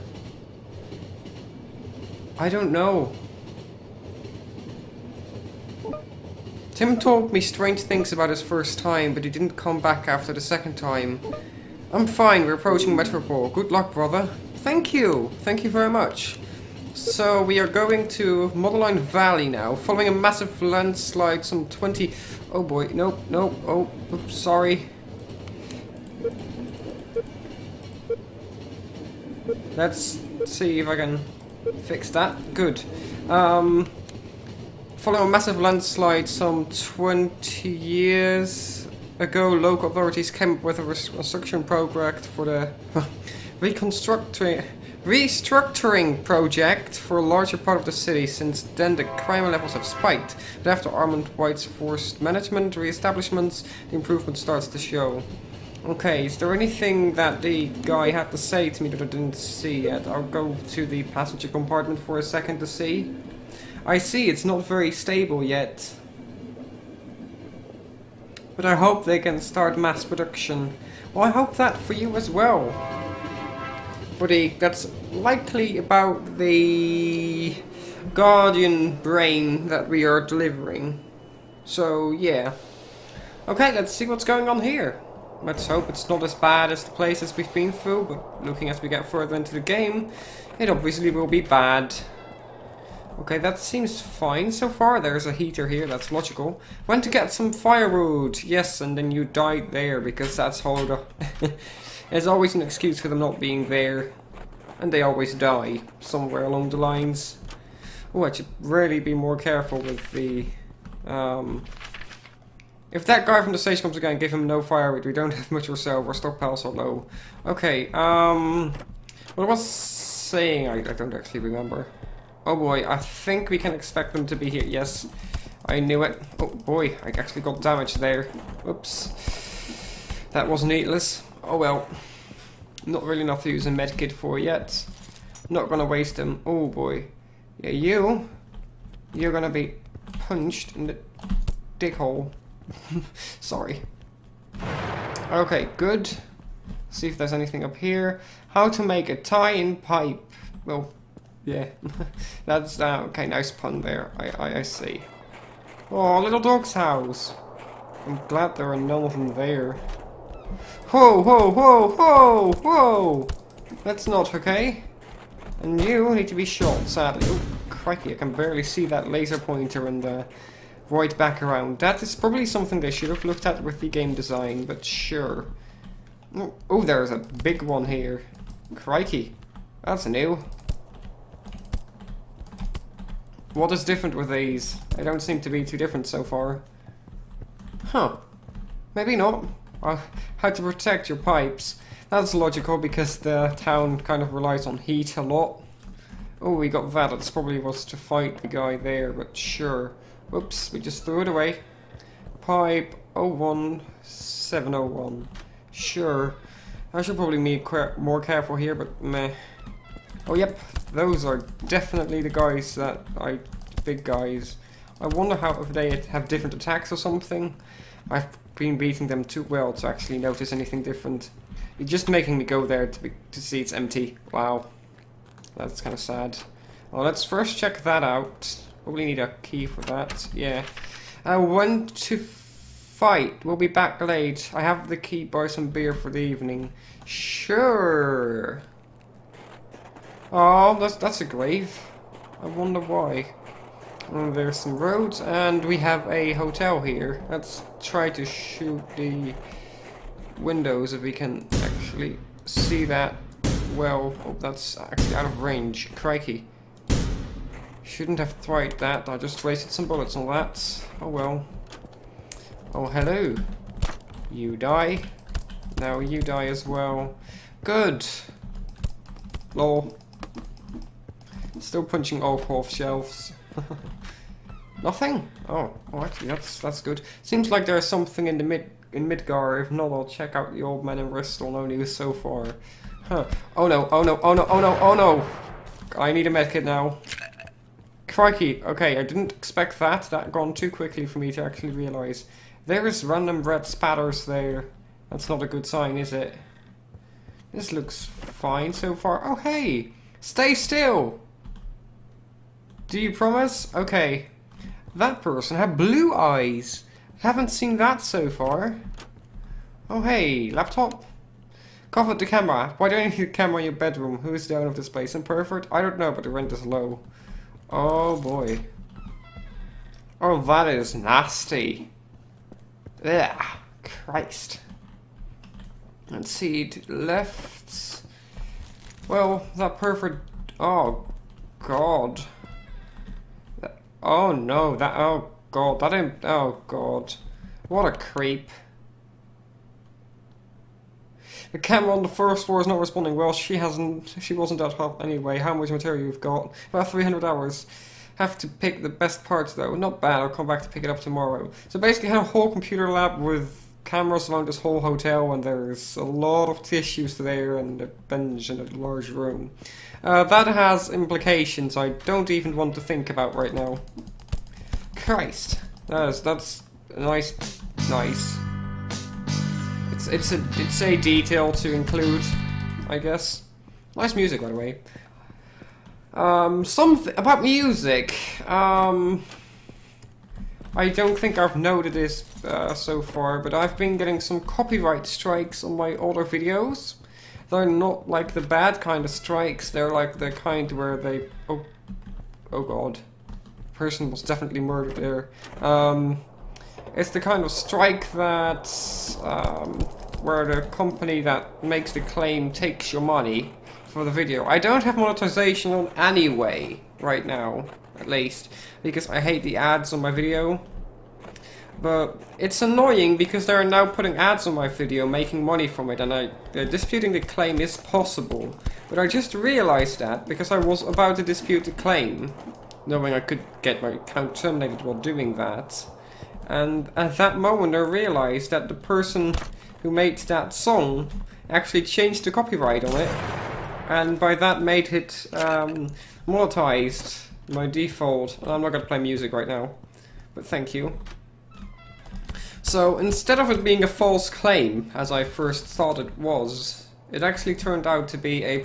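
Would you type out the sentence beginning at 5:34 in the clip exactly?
Oh no, that, oh god, that didn't, oh god.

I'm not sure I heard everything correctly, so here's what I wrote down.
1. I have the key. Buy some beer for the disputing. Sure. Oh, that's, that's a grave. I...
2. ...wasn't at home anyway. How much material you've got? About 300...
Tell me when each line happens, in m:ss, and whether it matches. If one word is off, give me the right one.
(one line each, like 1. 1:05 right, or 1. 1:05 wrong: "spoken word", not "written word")
1. 3:54 wrong: "evening", not "disputing"
2. 5:44 right.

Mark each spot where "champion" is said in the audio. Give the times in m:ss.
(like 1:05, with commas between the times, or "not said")
not said.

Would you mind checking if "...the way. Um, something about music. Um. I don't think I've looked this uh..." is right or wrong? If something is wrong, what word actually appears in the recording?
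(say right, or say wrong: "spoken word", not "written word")
wrong: "noted", not "looked".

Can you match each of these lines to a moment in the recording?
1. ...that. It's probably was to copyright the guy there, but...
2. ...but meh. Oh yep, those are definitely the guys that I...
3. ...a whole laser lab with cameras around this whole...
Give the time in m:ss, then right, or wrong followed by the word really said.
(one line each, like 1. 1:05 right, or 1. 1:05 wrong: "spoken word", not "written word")
1. 3:16 wrong: "fight", not "copyright"
2. 3:28 right
3. 5:52 wrong: "computer", not "laser".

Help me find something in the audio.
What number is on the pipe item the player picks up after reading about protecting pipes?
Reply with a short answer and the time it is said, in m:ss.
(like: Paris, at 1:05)
01701, at 3:23.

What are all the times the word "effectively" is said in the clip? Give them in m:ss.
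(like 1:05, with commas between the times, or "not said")
not said.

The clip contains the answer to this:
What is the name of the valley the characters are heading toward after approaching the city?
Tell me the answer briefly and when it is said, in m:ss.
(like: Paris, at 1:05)
Modeline Valley, at 0:18.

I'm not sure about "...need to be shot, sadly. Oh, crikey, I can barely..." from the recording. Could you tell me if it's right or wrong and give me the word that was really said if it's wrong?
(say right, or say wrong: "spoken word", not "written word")
right.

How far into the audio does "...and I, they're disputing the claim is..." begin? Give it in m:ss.
6:55.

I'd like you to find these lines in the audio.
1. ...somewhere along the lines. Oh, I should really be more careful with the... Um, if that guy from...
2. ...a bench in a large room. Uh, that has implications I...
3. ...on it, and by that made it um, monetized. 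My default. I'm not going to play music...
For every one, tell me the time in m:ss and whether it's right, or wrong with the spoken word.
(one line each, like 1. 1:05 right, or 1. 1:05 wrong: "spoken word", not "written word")
1. 1:45 right
2. 5:57 right
3. 7:12 right.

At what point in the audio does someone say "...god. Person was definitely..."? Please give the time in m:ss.
6:32.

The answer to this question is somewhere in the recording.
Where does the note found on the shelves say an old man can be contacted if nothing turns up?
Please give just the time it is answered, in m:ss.
4:41.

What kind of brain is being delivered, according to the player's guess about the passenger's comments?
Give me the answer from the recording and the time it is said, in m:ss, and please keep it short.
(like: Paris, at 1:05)
Guardian brain, at 1:18.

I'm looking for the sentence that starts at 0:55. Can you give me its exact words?
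Okay, is there anything that the guy had to say to me that I didn't see yet?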